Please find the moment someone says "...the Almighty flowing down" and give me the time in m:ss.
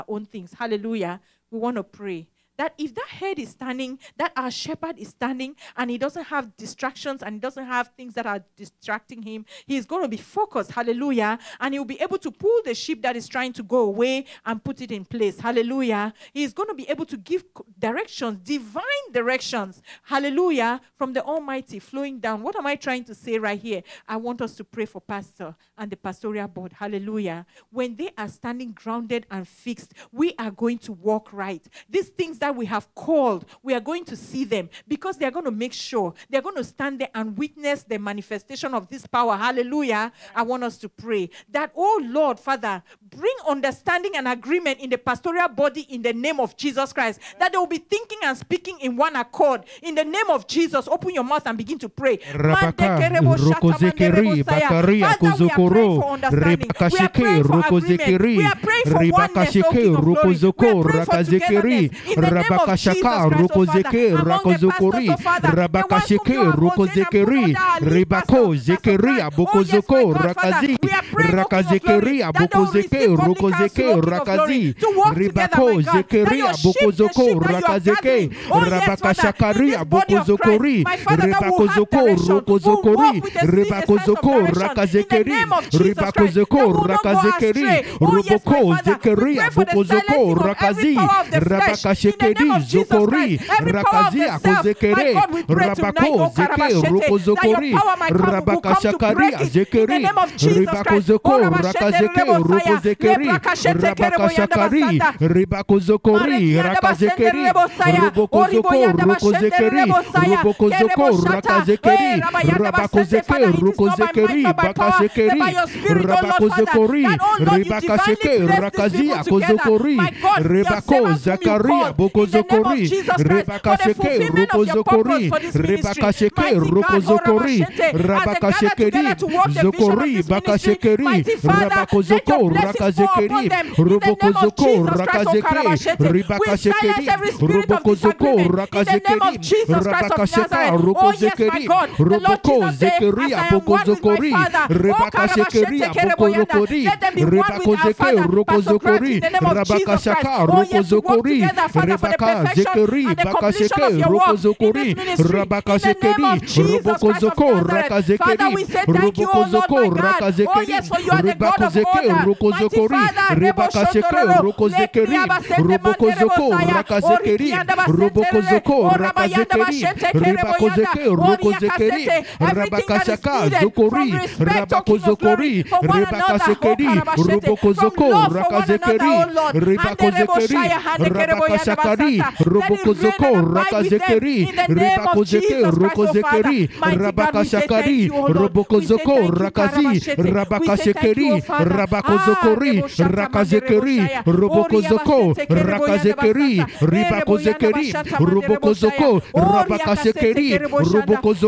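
0:21.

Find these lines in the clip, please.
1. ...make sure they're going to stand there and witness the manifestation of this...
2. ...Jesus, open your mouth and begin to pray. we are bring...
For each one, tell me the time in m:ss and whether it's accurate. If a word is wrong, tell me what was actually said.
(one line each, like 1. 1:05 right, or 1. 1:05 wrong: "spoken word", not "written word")
1. 0:35 right
2. 0:50 wrong: "praying", not "bring".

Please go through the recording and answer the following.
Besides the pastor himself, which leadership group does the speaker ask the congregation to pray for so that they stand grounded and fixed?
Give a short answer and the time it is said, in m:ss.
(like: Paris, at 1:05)
pastoral board, at 0:25.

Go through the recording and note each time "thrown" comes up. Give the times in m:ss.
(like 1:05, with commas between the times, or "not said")
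not said.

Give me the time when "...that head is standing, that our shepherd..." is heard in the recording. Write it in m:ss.
0:02.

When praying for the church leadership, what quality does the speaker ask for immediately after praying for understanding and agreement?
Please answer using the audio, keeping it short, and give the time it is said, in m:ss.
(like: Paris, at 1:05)
oneness, at 0:59.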